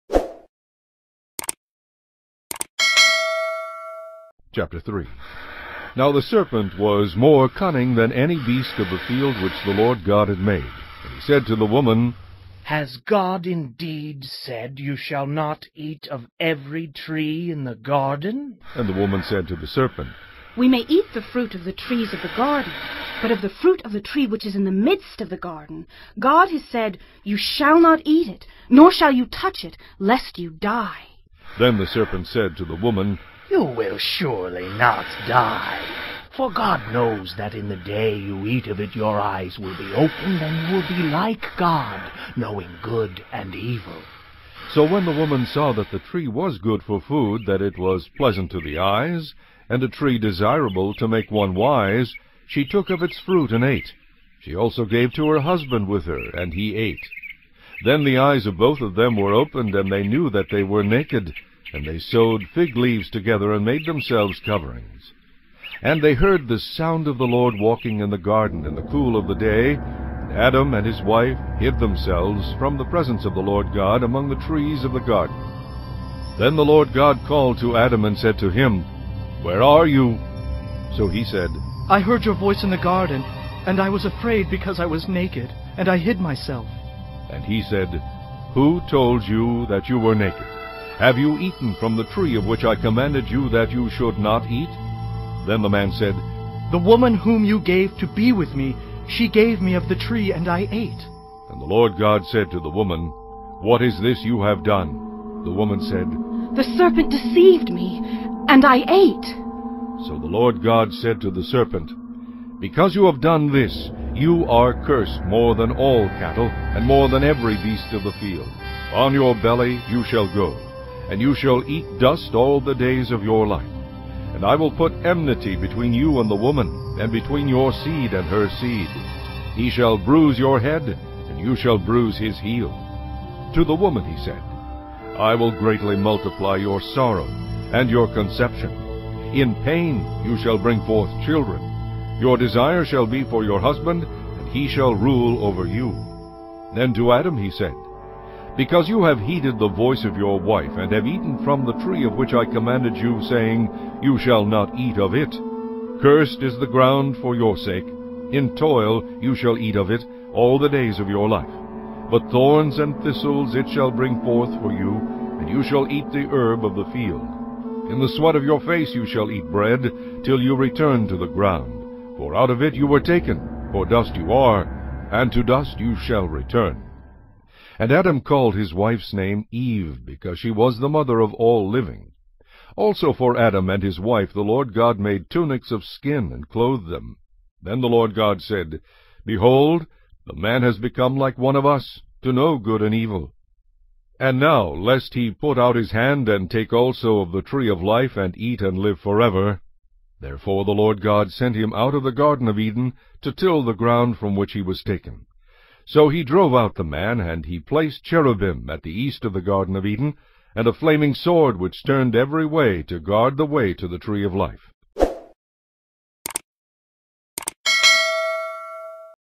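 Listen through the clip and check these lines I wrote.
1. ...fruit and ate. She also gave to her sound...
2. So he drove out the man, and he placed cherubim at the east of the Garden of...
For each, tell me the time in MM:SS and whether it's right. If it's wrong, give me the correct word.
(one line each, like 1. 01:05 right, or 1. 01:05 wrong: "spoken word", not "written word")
1. 00:53 wrong: "husband", not "sound"
2. 03:25 right.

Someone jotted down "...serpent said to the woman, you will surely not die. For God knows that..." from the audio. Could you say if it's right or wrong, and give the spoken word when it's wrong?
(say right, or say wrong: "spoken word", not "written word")
right.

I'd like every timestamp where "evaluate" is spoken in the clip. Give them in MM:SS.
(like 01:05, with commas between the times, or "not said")
not said.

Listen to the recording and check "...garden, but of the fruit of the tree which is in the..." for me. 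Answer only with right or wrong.
right.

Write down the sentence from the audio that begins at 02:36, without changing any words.
Cursed is the ground for your sake.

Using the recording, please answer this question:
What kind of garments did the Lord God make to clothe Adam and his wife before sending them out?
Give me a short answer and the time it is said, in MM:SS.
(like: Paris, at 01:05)
tunics of skin, at 03:05.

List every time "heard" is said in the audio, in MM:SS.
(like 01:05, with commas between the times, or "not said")
01:06, 01:21.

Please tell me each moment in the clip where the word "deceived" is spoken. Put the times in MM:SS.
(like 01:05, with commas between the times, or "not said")
01:47.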